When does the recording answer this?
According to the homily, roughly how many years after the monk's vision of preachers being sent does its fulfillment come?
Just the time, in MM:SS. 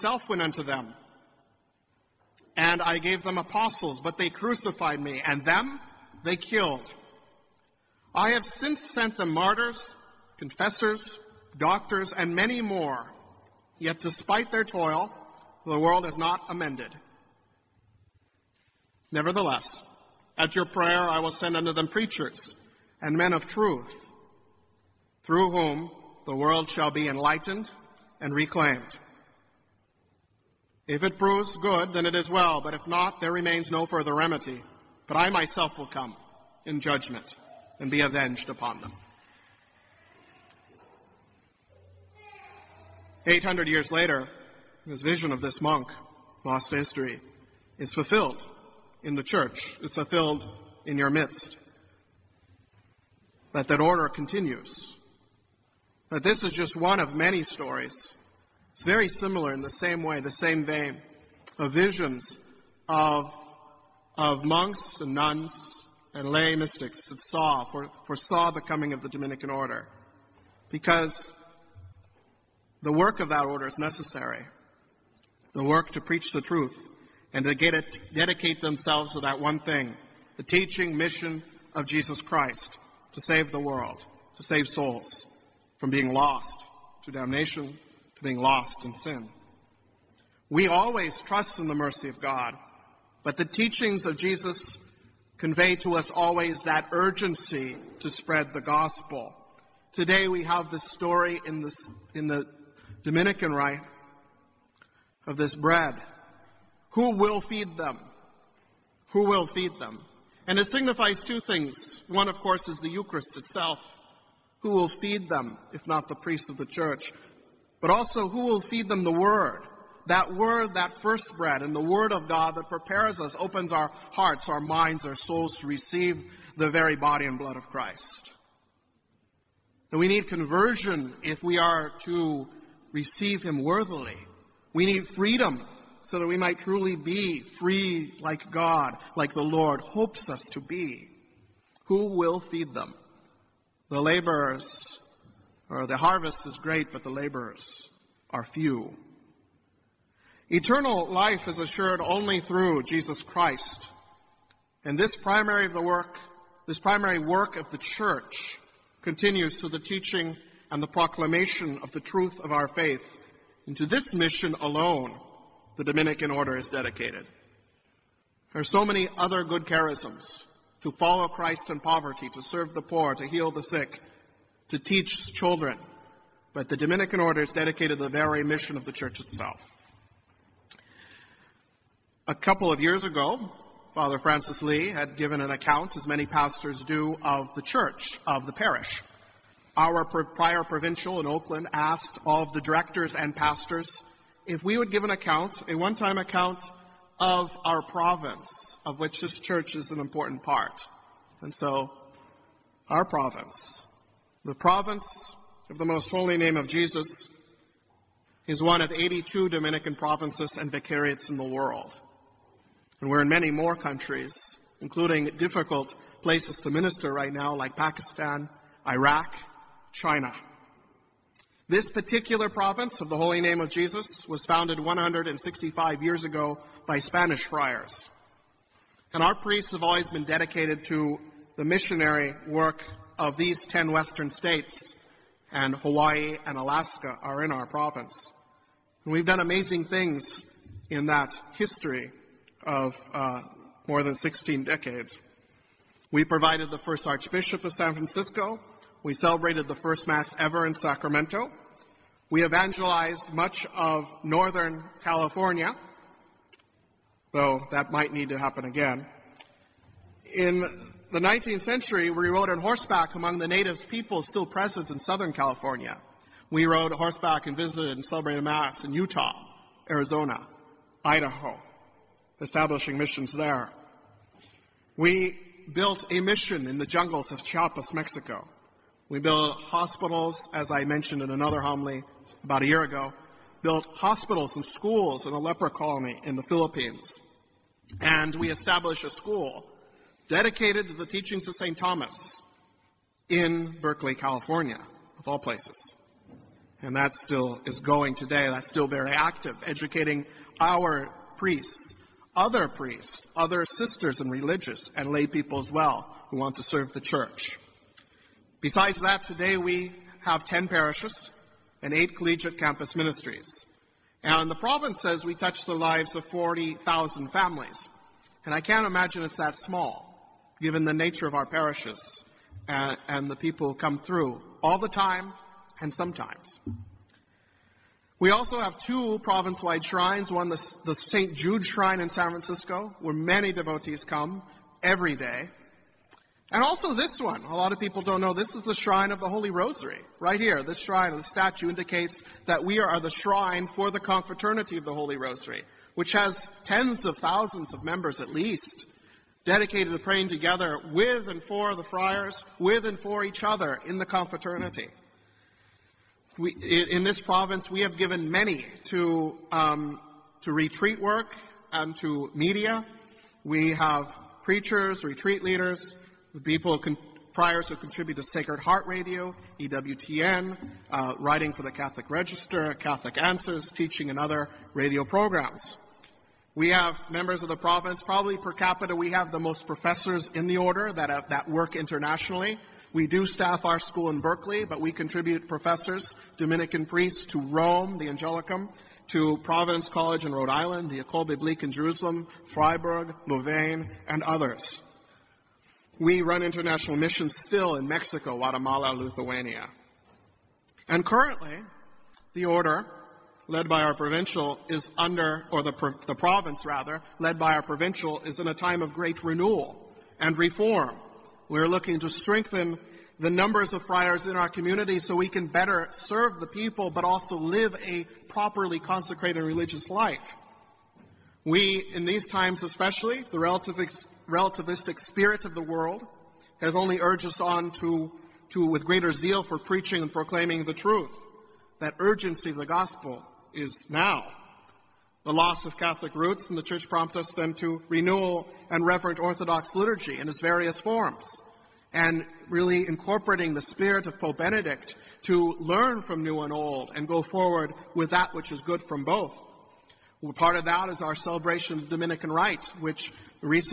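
00:43.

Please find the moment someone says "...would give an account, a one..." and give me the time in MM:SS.
03:14.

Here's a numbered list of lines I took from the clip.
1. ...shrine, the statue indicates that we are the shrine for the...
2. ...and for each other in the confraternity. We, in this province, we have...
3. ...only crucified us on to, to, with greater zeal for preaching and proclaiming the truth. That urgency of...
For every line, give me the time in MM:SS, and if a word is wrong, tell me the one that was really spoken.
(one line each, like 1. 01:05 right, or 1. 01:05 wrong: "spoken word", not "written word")
1. 05:40 right
2. 05:52 right
3. 07:06 wrong: "urged", not "crucified".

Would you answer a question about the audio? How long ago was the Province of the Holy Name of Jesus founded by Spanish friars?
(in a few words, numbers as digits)
165 years.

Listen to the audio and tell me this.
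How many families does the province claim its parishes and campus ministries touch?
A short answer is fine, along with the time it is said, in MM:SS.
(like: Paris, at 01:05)
40,000, at 05:16.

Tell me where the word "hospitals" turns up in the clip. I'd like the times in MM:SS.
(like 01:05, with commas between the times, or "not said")
04:39, 04:43.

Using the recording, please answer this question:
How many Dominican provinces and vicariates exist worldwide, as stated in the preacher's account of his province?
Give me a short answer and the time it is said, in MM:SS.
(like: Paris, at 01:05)
82, at 03:28.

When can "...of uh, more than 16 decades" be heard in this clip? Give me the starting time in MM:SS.
04:02.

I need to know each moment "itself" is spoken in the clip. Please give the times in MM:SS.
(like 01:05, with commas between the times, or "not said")
01:53, 02:59.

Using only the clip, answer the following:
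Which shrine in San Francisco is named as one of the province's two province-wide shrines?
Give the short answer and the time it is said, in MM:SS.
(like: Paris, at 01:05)
St. Jude Shrine, at 05:30.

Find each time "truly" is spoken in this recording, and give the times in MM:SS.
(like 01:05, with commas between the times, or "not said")
02:16.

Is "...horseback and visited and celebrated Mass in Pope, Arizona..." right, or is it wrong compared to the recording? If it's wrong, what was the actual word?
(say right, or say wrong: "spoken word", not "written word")
wrong: "Utah", not "Pope".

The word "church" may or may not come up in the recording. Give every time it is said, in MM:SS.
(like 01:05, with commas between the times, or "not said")
00:49, 01:56, 02:37, 02:58, 03:07, 03:19, 05:07, 07:16.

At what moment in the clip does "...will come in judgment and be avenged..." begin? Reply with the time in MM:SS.
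00:35.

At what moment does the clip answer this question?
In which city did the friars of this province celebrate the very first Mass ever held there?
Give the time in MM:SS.
04:10.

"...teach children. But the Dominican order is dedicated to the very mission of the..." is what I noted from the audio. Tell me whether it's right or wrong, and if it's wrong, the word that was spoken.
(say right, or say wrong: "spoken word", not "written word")
right.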